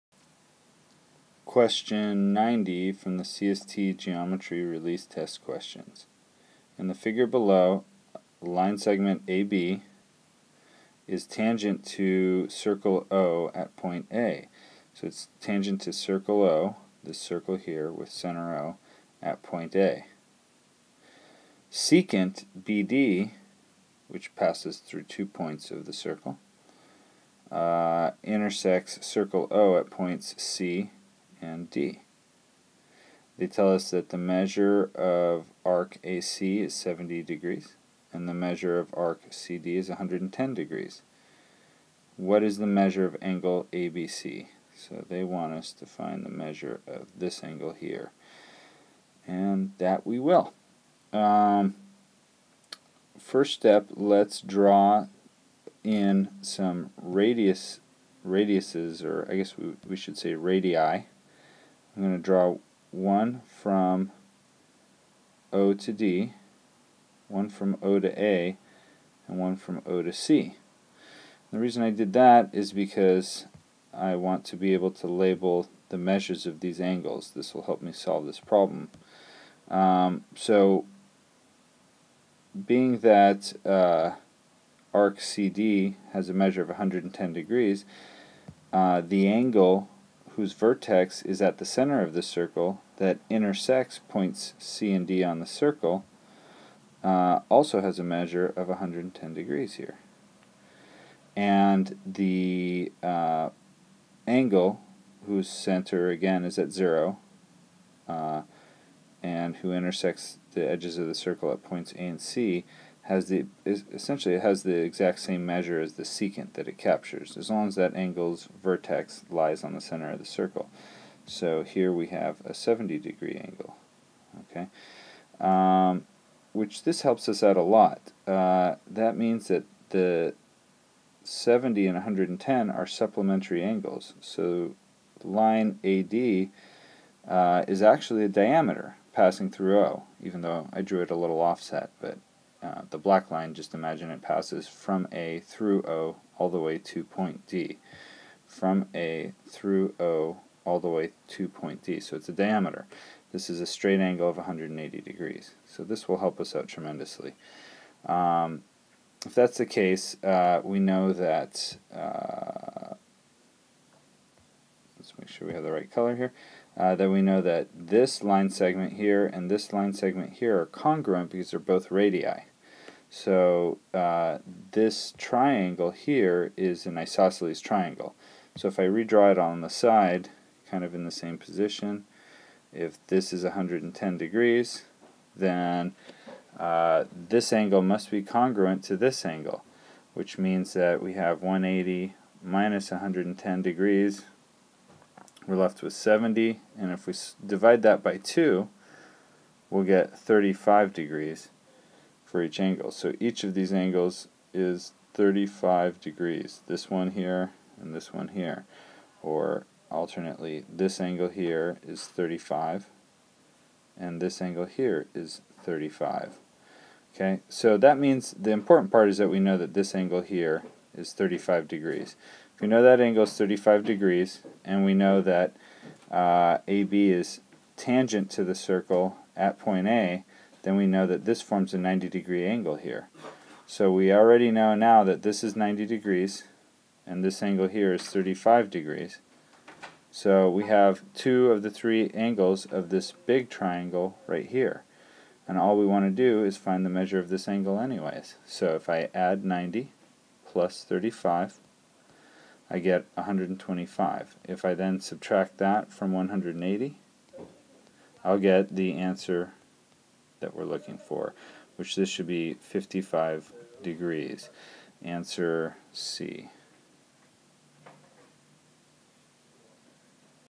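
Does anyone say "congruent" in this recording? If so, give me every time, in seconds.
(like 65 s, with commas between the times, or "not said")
170 s, 188 s.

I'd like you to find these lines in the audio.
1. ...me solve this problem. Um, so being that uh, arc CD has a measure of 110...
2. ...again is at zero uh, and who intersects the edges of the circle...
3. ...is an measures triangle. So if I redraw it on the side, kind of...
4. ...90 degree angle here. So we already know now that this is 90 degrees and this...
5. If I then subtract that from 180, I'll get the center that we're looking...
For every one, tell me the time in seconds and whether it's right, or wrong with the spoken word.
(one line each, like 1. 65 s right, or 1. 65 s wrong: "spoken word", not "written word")
1. 77 s right
2. 106 s right
3. 176 s wrong: "isosceles", not "measures"
4. 231 s right
5. 254 s wrong: "answer", not "center".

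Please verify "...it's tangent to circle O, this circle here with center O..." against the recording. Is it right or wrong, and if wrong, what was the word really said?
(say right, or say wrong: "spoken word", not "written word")
right.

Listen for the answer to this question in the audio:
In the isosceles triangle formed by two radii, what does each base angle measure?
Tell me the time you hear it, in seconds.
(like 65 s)
200 s.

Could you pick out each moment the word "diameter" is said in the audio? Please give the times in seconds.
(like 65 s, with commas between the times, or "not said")
138 s, 152 s.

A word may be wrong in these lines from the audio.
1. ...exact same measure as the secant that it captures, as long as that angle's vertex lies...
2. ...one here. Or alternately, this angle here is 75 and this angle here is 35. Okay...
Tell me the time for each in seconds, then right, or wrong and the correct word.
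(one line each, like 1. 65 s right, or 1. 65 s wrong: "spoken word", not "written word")
1. 114 s right
2. 208 s wrong: "35", not "75".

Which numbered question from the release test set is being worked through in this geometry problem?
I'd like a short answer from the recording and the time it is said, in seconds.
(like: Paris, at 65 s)
90, at 1 s.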